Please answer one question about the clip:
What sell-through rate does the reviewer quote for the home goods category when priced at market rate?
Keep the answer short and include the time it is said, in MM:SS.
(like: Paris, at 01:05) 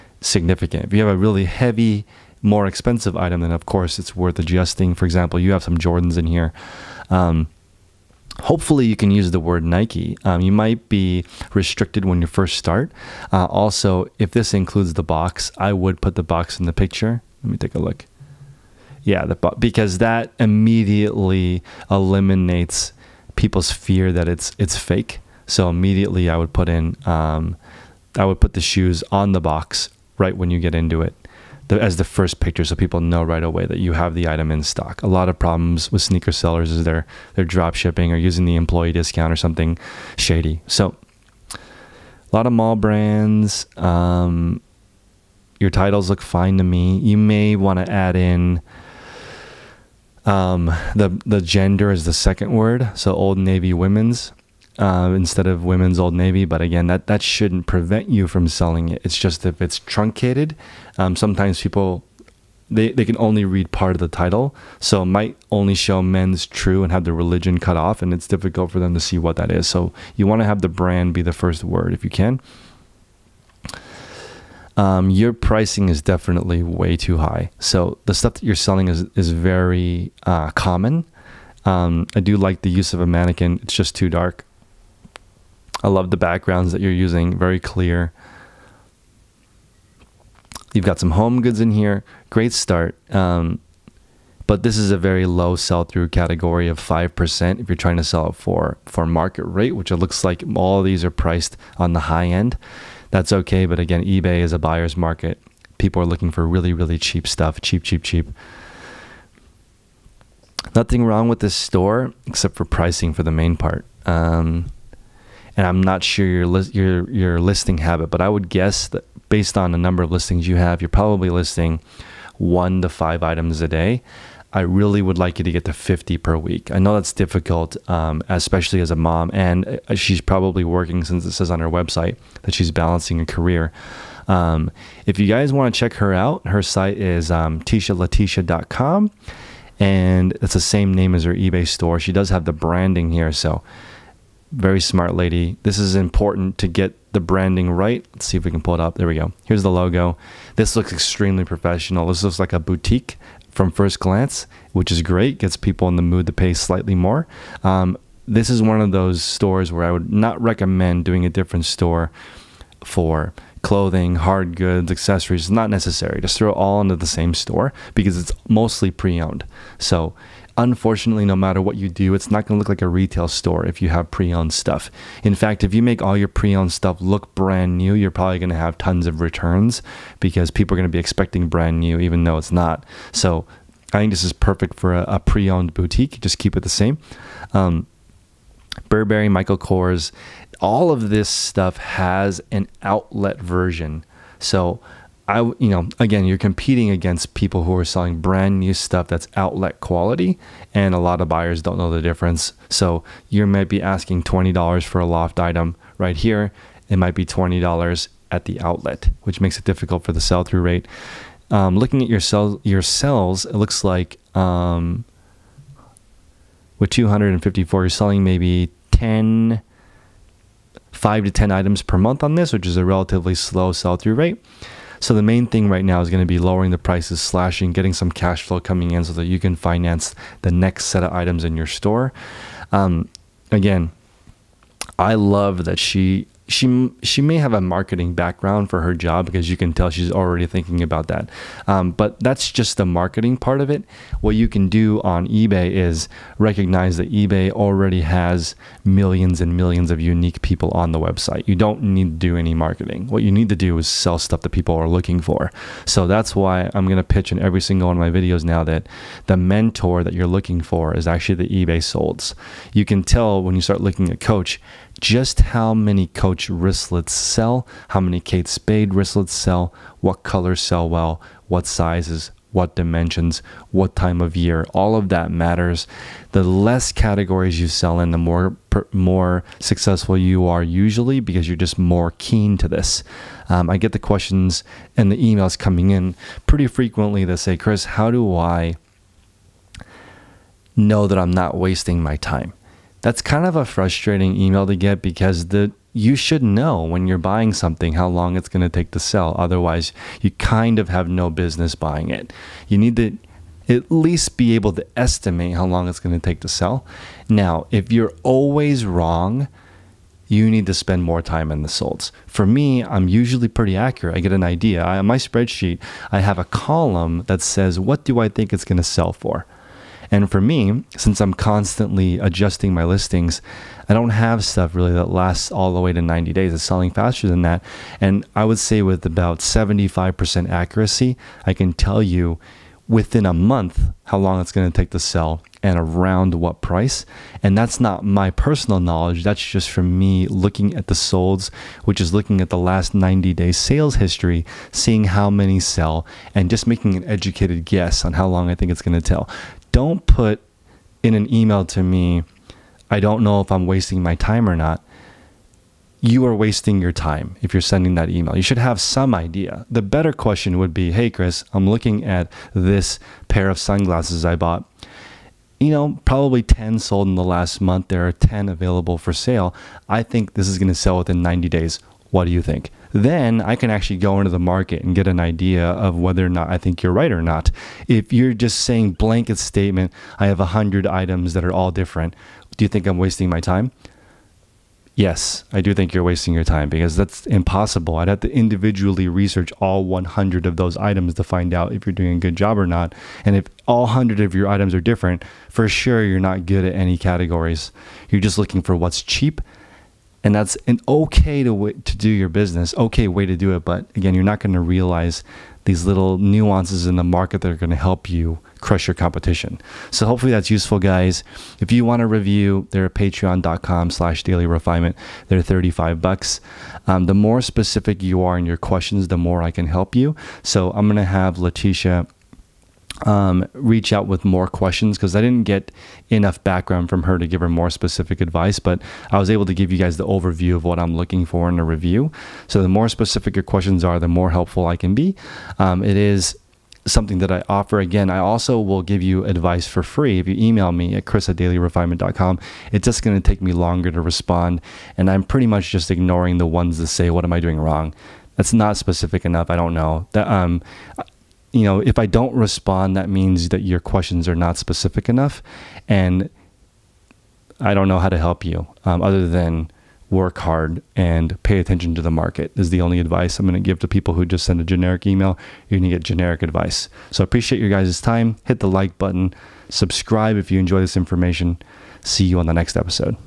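5%, at 01:36.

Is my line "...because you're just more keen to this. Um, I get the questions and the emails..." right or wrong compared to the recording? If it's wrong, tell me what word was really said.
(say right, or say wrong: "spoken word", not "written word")
right.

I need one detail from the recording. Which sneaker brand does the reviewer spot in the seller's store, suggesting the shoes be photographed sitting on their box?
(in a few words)
Jordans.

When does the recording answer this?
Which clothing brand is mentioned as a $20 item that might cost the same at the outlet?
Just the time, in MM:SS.
03:25.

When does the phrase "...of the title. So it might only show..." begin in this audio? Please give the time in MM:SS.
01:03.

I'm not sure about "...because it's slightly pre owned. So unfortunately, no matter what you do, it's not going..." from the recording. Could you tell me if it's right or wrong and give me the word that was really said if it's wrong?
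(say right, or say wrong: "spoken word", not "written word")
wrong: "mostly", not "slightly".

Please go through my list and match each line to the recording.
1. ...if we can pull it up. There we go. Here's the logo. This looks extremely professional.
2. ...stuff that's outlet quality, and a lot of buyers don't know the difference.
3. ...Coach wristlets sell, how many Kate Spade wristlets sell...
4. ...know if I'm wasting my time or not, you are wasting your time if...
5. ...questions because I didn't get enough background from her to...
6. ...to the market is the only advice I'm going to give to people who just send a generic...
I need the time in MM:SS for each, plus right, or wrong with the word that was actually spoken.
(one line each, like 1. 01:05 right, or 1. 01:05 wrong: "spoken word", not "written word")
1. 02:28 right
2. 03:18 right
3. 04:26 right
4. 05:53 right
5. 07:04 right
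6. 07:41 right.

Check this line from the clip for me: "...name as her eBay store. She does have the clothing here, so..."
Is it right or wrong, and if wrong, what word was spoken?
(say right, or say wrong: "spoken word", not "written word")
wrong: "branding", not "clothing".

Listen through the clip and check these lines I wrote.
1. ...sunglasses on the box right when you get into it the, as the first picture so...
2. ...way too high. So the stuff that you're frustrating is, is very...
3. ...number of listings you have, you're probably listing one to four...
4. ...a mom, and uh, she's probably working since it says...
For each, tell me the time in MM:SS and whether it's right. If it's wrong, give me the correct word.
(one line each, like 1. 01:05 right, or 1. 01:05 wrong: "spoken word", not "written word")
1. 00:28 wrong: "shoes", not "sunglasses"
2. 01:16 wrong: "selling", not "frustrating"
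3. 01:59 wrong: "five", not "four"
4. 02:08 right.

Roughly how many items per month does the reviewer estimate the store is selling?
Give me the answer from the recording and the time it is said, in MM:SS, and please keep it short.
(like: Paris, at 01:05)
5 to 10, at 03:40.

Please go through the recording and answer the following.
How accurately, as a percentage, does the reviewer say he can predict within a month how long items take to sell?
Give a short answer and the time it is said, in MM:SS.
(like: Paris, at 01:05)
75%, at 05:29.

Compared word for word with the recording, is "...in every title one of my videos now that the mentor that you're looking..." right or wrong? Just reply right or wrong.
wrong.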